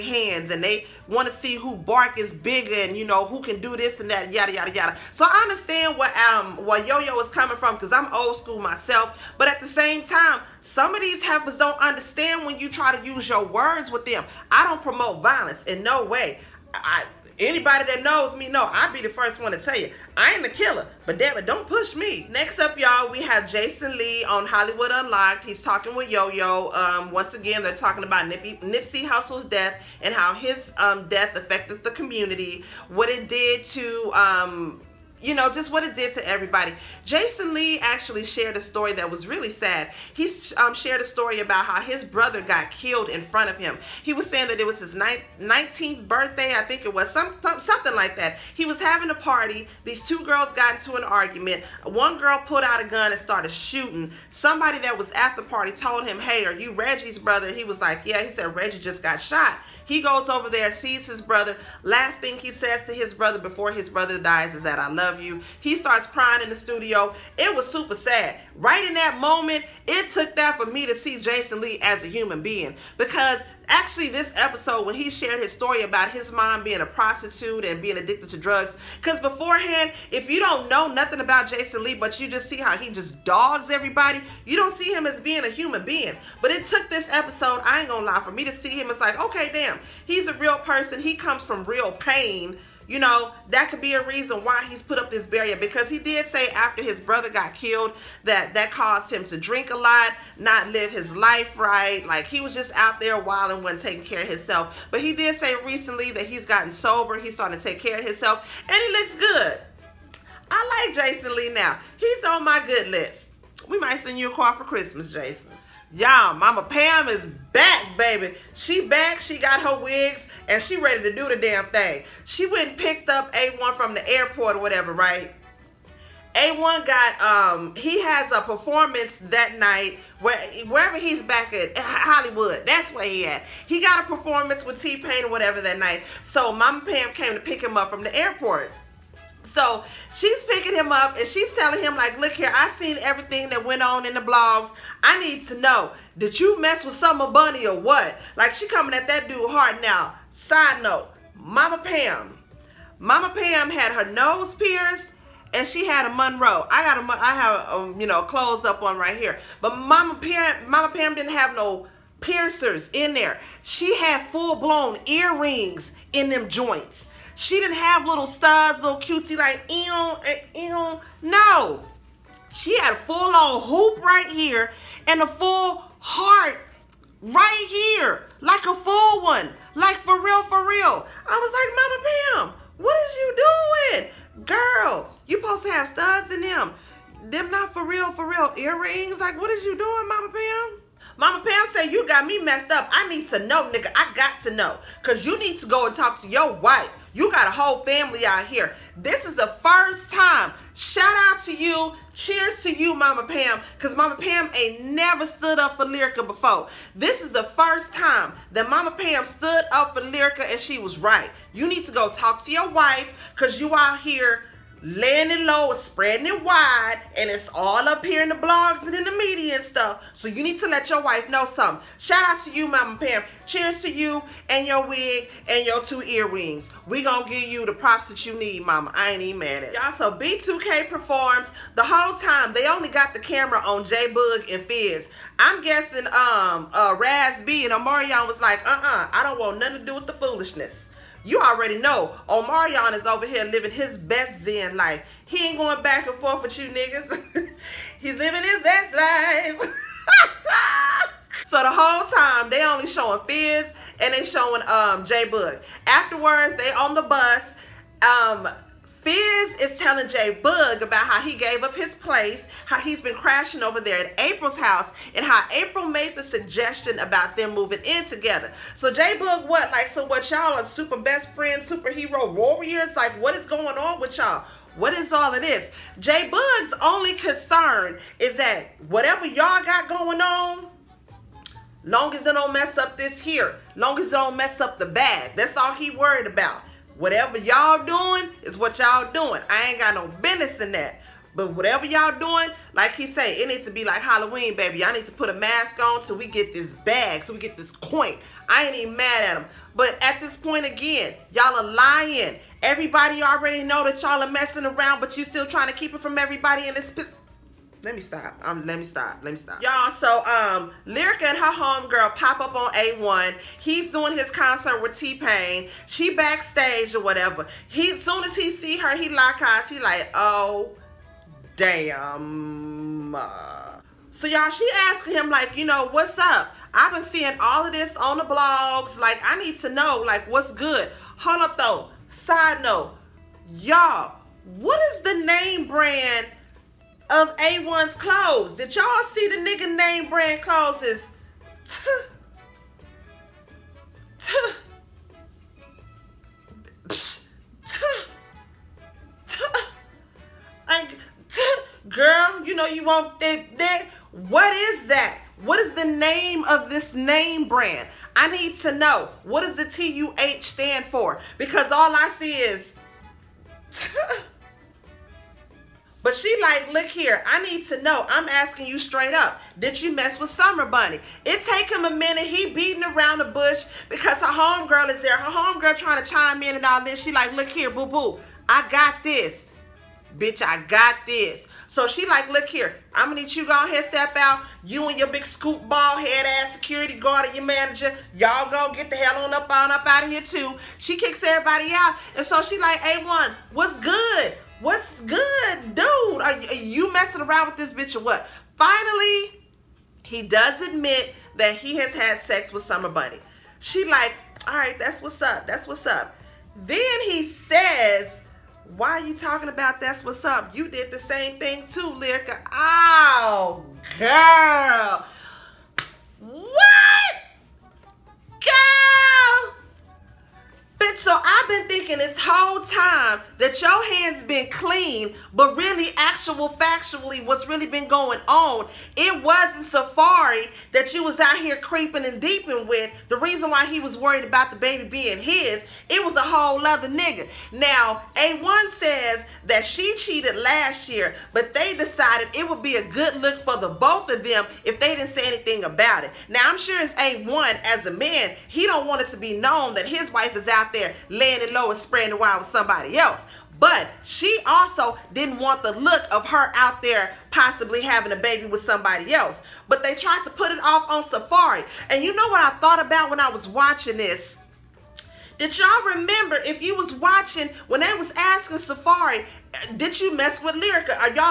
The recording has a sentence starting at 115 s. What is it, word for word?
Y'all, Mama Pam is back, baby.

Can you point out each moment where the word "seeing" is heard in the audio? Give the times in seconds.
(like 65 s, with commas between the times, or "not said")
327 s.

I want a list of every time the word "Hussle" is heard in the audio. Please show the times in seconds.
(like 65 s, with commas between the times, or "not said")
29 s.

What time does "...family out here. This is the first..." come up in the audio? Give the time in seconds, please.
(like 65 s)
197 s.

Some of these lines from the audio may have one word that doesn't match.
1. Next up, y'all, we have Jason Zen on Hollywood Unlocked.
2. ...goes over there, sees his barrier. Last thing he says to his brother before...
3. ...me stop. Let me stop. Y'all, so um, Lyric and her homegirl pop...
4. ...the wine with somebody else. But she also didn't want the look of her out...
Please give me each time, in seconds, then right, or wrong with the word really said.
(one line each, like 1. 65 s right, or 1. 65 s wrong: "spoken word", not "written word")
1. 22 s wrong: "Lee", not "Zen"
2. 60 s wrong: "brother", not "barrier"
3. 308 s right
4. 452 s right.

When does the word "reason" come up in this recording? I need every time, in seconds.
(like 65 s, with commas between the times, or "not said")
94 s, 433 s.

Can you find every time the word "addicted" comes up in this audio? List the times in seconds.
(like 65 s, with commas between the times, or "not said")
77 s.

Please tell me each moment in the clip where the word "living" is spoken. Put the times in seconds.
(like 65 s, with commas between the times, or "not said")
243 s, 248 s.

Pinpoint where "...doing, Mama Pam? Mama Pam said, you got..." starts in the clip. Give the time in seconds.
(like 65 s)
189 s.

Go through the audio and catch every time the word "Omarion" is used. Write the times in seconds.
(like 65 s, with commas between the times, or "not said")
237 s, 242 s.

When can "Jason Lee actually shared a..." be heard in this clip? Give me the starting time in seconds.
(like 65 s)
37 s.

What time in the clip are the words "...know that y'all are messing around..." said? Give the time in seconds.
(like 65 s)
303 s.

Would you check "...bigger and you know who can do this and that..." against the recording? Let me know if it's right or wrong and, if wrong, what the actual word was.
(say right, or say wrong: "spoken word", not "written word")
right.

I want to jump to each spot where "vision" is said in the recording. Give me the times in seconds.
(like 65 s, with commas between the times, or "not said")
not said.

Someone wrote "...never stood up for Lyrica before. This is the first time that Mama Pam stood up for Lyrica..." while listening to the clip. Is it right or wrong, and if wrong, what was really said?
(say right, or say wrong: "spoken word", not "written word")
right.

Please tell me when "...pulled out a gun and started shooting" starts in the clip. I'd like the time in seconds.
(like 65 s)
52 s.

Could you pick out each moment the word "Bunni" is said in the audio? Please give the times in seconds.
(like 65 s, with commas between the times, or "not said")
147 s, 370 s, 402 s.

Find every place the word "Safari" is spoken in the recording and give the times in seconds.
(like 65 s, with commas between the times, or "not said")
429 s, 461 s, 468 s.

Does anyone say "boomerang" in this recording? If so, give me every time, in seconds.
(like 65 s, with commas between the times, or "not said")
not said.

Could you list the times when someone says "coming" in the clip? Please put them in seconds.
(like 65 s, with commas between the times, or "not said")
7 s, 148 s.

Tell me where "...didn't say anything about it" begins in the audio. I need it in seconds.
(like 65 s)
444 s.